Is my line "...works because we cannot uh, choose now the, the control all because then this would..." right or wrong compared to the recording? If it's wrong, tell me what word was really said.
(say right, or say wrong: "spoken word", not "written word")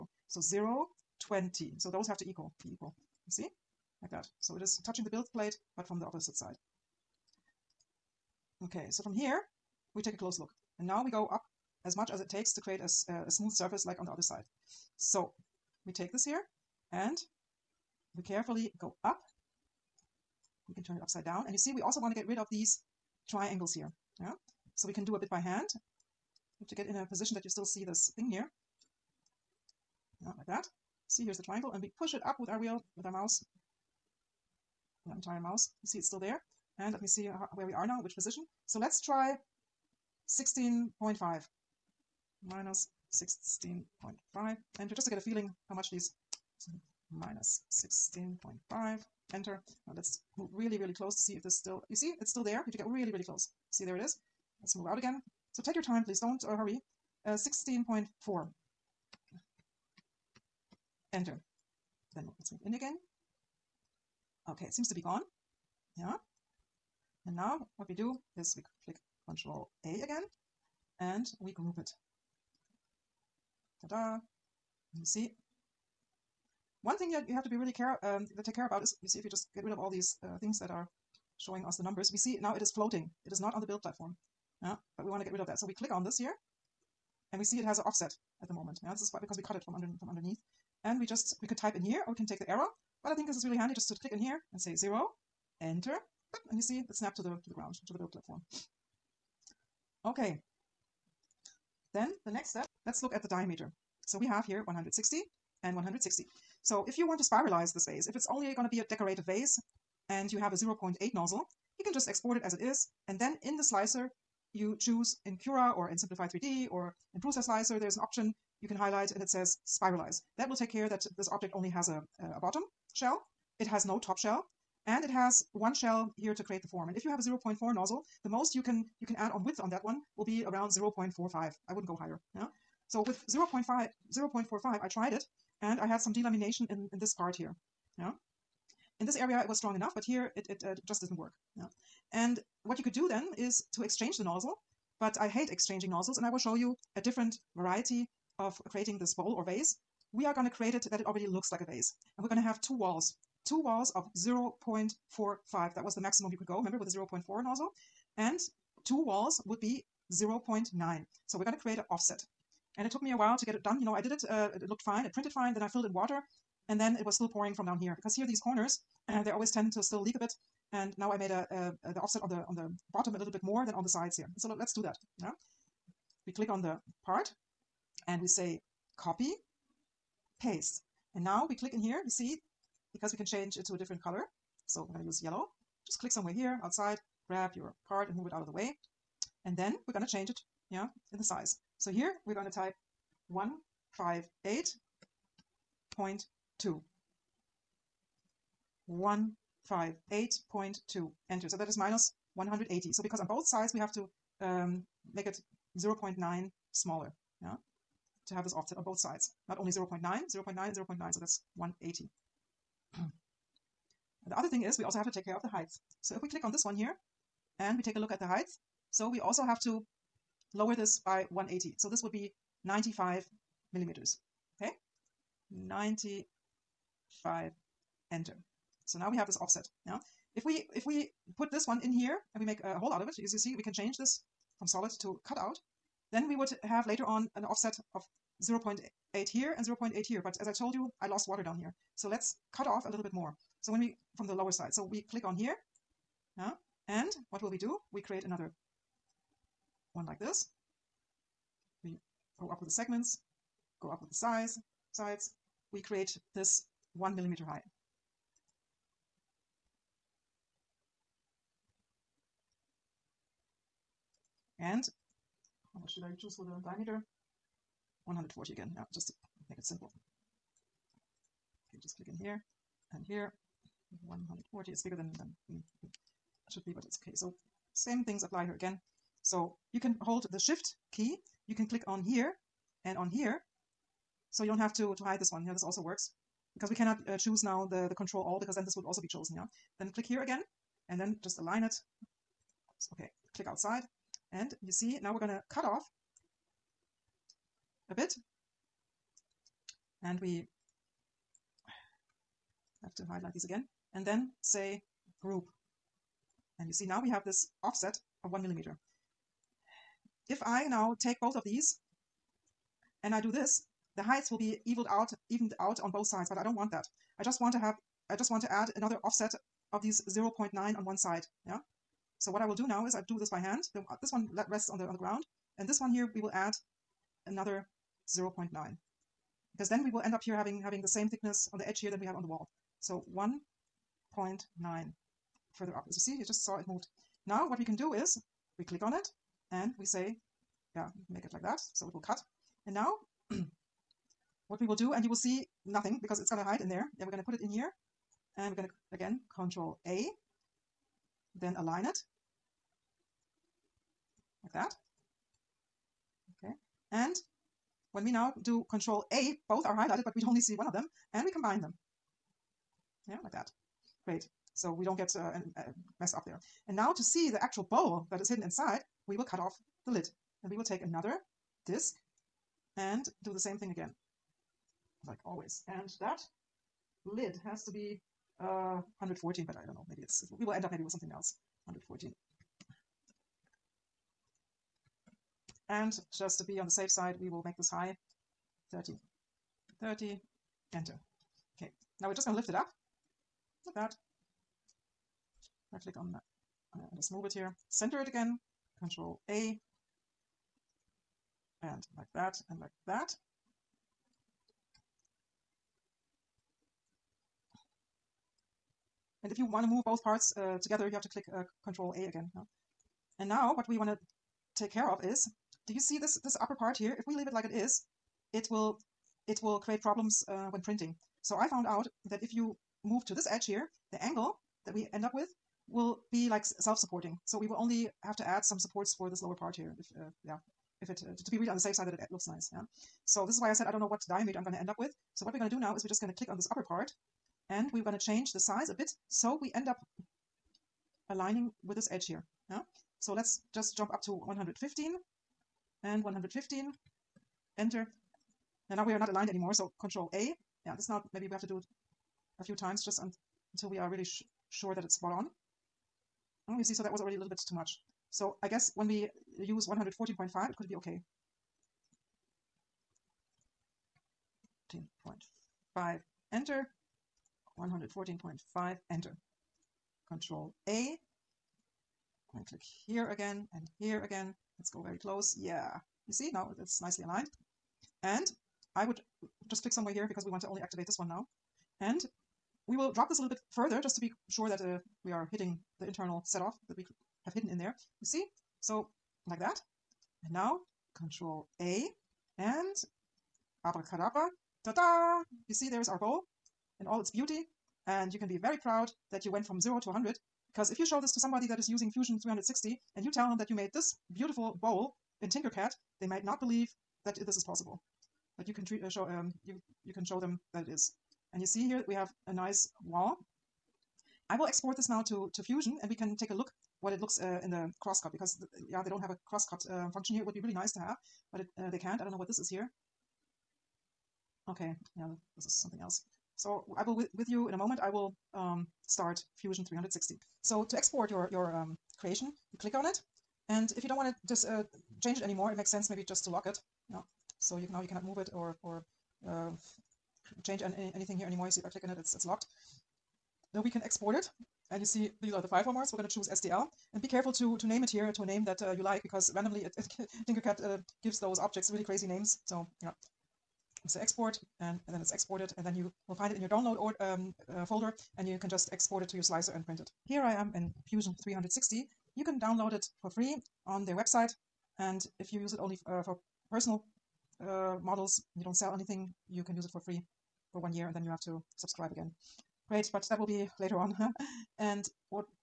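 right.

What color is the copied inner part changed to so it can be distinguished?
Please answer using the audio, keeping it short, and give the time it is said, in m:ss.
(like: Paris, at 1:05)
yellow, at 3:05.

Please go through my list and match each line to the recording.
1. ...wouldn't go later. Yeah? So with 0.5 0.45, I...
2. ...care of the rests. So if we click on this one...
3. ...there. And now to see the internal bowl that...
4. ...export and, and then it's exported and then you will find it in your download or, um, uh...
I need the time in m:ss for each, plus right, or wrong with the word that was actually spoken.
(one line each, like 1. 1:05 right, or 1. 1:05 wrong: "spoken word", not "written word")
1. 2:11 wrong: "higher", not "later"
2. 3:35 wrong: "heights", not "rests"
3. 6:06 wrong: "actual", not "internal"
4. 9:14 right.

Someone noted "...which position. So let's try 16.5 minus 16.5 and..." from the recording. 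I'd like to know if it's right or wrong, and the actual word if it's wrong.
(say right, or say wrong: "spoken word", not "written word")
right.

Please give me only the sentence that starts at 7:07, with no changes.
So we will only have to add some supports for this lower part here.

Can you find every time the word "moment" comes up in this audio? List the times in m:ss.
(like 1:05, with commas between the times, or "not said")
1:28, 8:47.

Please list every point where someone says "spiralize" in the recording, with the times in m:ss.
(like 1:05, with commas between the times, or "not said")
1:47, 1:59.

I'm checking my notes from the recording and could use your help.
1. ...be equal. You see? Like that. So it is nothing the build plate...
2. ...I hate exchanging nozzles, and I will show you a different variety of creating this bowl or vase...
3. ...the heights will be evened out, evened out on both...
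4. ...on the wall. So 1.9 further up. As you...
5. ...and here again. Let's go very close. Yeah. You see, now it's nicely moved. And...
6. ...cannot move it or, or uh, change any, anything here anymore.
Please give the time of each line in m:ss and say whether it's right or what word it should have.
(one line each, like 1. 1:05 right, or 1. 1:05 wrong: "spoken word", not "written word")
1. 0:02 wrong: "touching", not "nothing"
2. 2:25 right
3. 5:13 right
4. 5:32 right
5. 7:53 wrong: "aligned", not "moved"
6. 8:57 right.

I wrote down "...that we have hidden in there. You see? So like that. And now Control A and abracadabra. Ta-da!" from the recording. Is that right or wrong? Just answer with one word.
right.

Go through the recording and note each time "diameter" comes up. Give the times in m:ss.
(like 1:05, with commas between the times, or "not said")
1:43, 4:26, 7:14.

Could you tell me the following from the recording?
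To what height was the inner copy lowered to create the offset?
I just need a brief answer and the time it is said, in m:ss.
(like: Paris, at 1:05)
95 millimeters, at 3:42.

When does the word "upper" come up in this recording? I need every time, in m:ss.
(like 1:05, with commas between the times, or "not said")
6:56, 7:16.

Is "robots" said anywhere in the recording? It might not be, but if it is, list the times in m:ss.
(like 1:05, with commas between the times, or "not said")
not said.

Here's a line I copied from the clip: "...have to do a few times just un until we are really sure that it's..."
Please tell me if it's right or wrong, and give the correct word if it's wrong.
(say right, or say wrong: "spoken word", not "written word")
right.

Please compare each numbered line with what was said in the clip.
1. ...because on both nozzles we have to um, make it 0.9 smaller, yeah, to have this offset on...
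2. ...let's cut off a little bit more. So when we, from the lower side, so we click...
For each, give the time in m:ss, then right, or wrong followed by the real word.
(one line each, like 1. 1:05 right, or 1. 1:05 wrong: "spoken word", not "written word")
1. 3:23 wrong: "sides", not "nozzles"
2. 4:02 right.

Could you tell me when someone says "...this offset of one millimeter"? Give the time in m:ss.
5:07.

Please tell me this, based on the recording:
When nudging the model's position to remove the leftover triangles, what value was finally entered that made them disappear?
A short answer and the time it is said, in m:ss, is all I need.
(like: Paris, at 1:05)
16.4, at 0:57.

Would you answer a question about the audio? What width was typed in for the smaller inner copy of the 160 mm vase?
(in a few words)
158.2.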